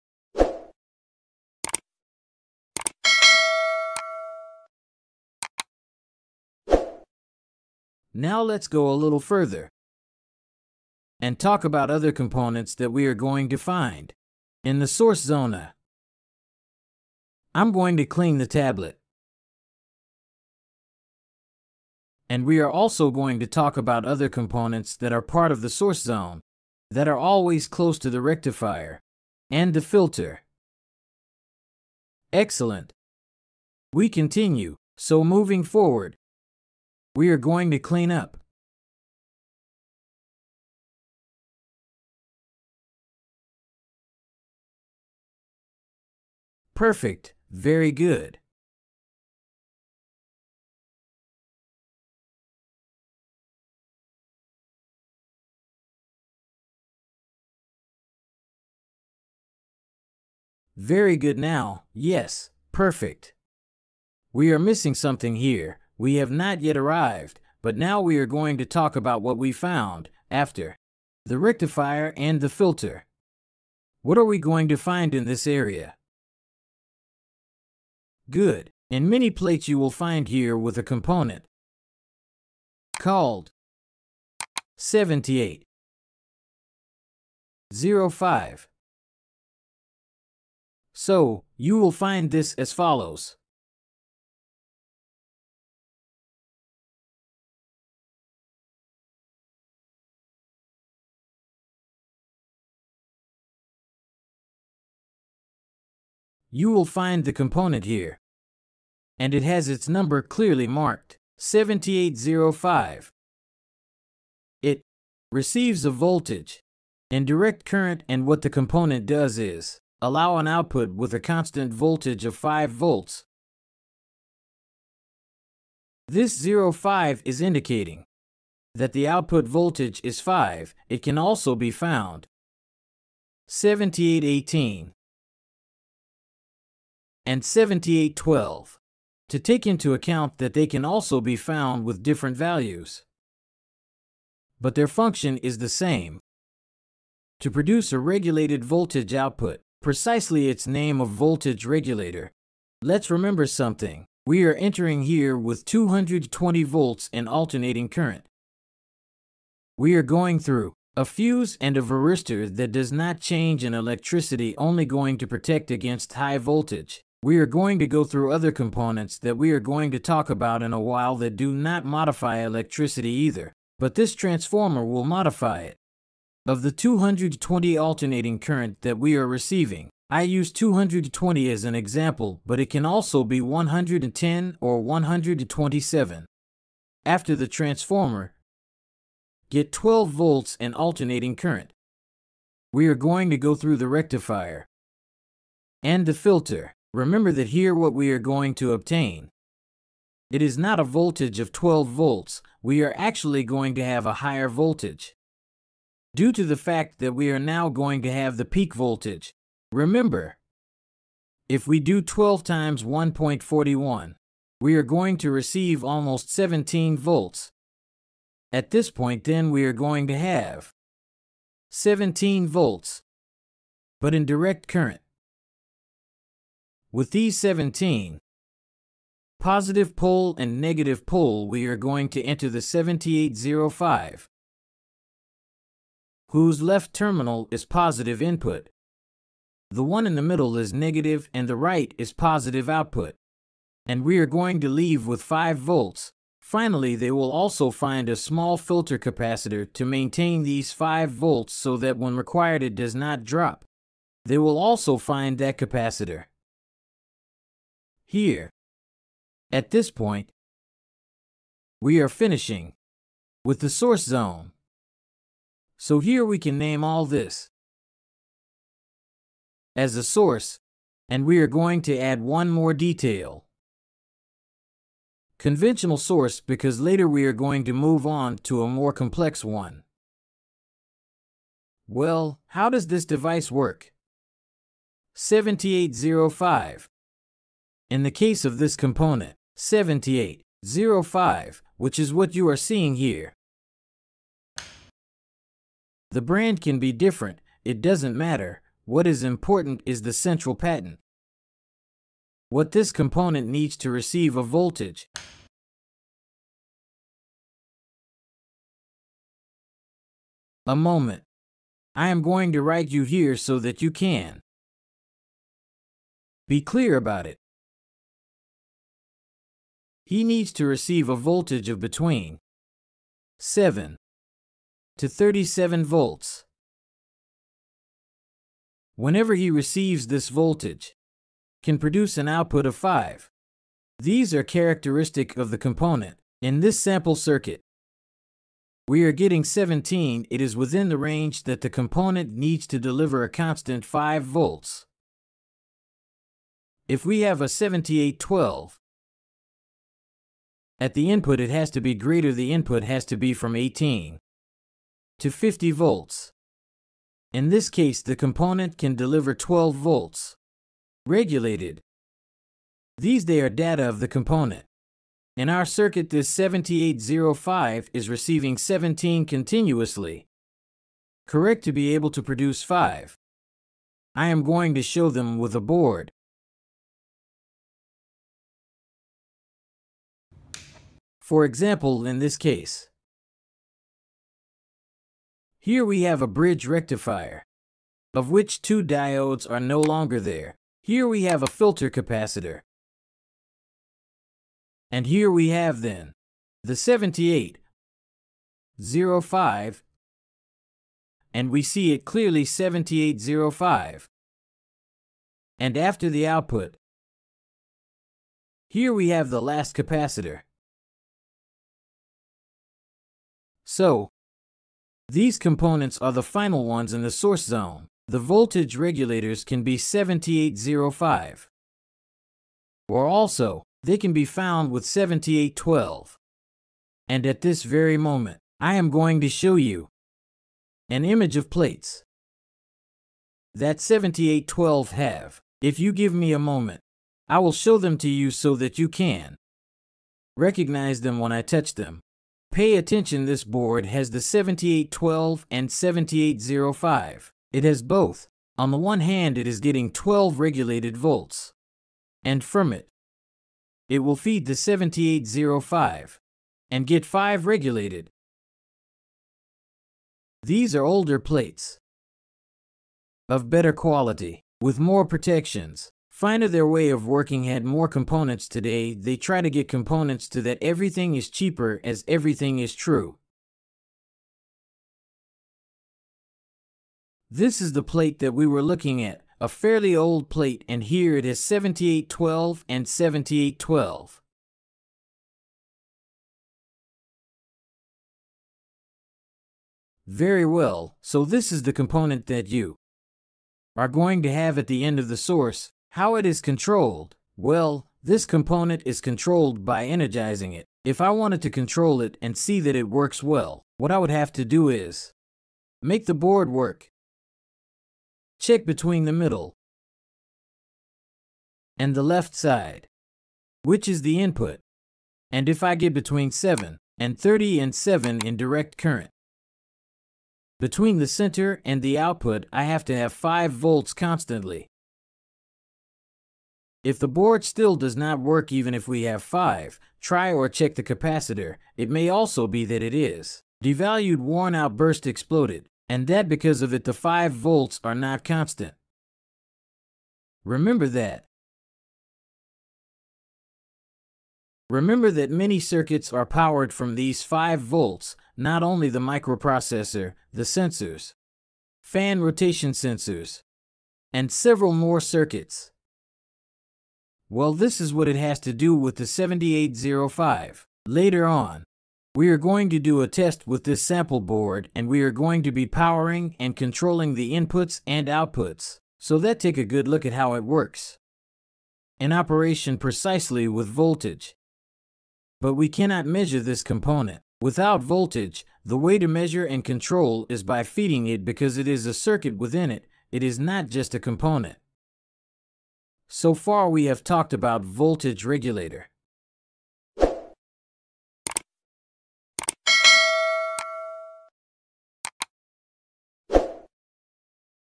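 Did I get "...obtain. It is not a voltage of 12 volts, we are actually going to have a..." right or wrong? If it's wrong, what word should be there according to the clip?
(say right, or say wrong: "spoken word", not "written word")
right.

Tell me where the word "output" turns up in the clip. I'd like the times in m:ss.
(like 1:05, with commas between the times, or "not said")
2:00, 2:09, 2:29, 4:02, 5:32, 6:46, 8:41, 9:28.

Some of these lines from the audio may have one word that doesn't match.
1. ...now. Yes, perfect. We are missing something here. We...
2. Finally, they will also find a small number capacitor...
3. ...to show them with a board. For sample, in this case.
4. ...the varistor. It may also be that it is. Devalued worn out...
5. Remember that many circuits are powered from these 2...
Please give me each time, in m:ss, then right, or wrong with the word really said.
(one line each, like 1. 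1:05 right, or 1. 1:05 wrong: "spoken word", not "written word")
1. 1:01 right
2. 4:06 wrong: "filter", not "number"
3. 6:14 wrong: "example", not "sample"
4. 8:50 wrong: "capacitor", not "varistor"
5. 9:04 wrong: "5", not "2".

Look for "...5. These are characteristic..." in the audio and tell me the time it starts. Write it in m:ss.
5:32.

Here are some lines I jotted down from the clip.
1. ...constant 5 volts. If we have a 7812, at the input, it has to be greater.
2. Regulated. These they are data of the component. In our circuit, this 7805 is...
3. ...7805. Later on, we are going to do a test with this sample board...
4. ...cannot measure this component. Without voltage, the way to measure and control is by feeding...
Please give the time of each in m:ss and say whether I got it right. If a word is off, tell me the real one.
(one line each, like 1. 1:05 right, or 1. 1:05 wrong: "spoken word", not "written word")
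1. 5:43 right
2. 6:01 right
3. 9:19 right
4. 9:35 right.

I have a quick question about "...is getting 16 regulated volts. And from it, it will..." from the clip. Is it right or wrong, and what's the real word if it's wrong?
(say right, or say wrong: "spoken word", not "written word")
wrong: "12", not "16".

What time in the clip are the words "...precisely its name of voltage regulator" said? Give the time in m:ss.
2:29.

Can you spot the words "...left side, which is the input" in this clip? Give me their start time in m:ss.
8:32.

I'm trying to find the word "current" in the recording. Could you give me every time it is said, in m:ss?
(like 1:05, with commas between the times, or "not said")
1:57, 2:37, 2:58, 3:11, 3:44, 8:38.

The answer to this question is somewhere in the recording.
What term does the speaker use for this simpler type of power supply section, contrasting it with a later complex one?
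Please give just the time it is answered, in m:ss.
4:35.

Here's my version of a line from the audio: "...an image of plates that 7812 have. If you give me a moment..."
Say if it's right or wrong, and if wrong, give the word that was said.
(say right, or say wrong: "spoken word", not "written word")
right.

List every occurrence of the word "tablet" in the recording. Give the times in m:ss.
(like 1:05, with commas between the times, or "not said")
0:18.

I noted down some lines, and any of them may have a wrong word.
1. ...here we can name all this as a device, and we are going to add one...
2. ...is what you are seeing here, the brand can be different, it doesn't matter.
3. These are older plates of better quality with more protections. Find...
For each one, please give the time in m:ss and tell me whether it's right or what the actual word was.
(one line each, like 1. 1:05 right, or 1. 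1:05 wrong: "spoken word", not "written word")
1. 4:25 wrong: "source", not "device"
2. 4:51 right
3. 7:40 right.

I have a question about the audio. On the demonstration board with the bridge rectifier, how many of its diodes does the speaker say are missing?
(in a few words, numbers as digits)
2.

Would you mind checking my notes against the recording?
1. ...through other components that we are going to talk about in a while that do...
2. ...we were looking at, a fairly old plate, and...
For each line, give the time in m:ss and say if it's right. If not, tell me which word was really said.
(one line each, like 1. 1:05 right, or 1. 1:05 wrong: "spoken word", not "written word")
1. 2:48 right
2. 7:58 right.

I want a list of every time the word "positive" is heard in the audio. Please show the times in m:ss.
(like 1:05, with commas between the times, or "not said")
3:49, 3:57, 4:02.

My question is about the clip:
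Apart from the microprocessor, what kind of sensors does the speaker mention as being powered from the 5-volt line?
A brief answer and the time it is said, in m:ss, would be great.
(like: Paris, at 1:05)
Fan rotation sensors, at 9:11.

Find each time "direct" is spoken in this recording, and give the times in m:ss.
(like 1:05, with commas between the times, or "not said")
1:57, 3:44, 8:38.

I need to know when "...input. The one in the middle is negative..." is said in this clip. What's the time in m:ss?
3:58.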